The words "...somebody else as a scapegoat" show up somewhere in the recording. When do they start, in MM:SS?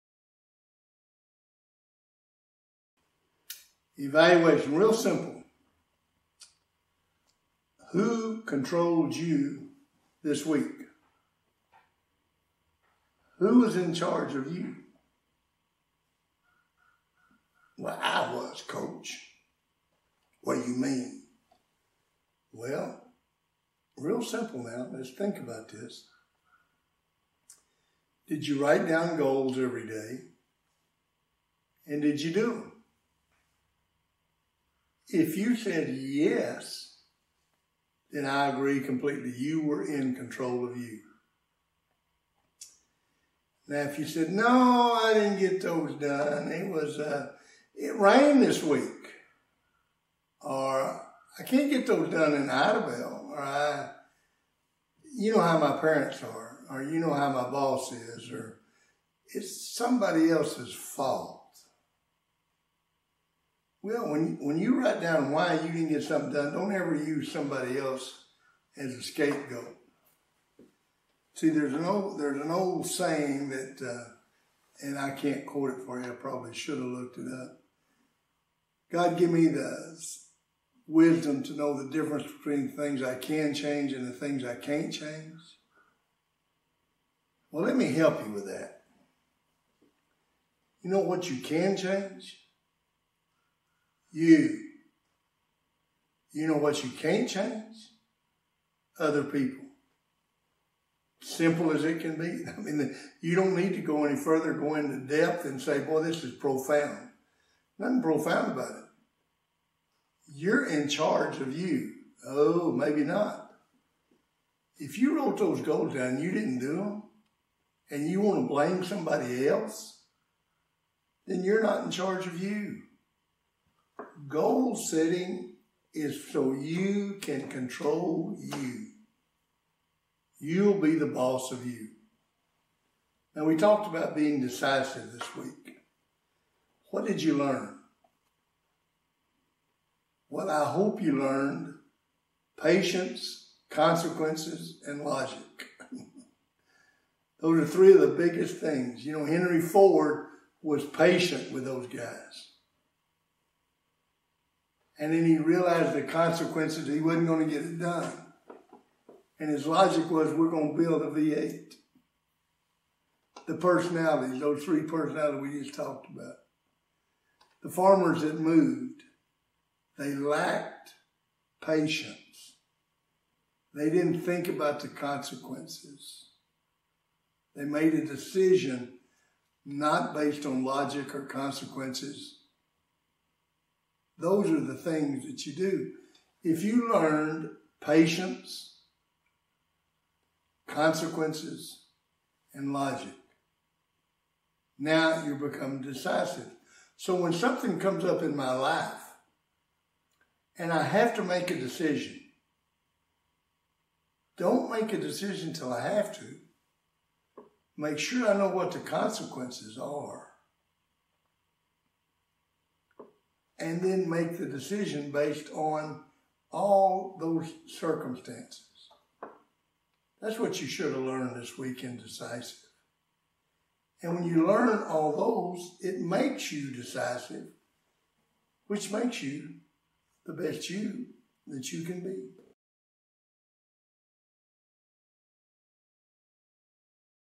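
01:07.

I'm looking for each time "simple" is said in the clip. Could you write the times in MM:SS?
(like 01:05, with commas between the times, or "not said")
00:04, 00:24, 01:41.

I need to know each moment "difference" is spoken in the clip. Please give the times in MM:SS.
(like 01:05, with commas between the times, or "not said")
01:21.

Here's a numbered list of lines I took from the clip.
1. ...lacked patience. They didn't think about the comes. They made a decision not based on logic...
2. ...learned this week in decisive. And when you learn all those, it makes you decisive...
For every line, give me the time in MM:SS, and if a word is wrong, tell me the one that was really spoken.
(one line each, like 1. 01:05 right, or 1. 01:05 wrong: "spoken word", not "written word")
1. 02:50 wrong: "consequences", not "comes"
2. 03:41 right.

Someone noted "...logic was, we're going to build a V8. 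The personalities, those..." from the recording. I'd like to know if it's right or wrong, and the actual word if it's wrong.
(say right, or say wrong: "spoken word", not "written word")
right.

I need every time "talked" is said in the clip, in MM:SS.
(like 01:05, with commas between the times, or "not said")
02:13, 02:45.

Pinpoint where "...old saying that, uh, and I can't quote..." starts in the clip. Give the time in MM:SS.
01:12.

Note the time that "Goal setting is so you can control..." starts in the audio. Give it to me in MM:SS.
02:04.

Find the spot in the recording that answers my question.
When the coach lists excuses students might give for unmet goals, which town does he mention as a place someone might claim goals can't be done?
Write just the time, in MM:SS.
00:52.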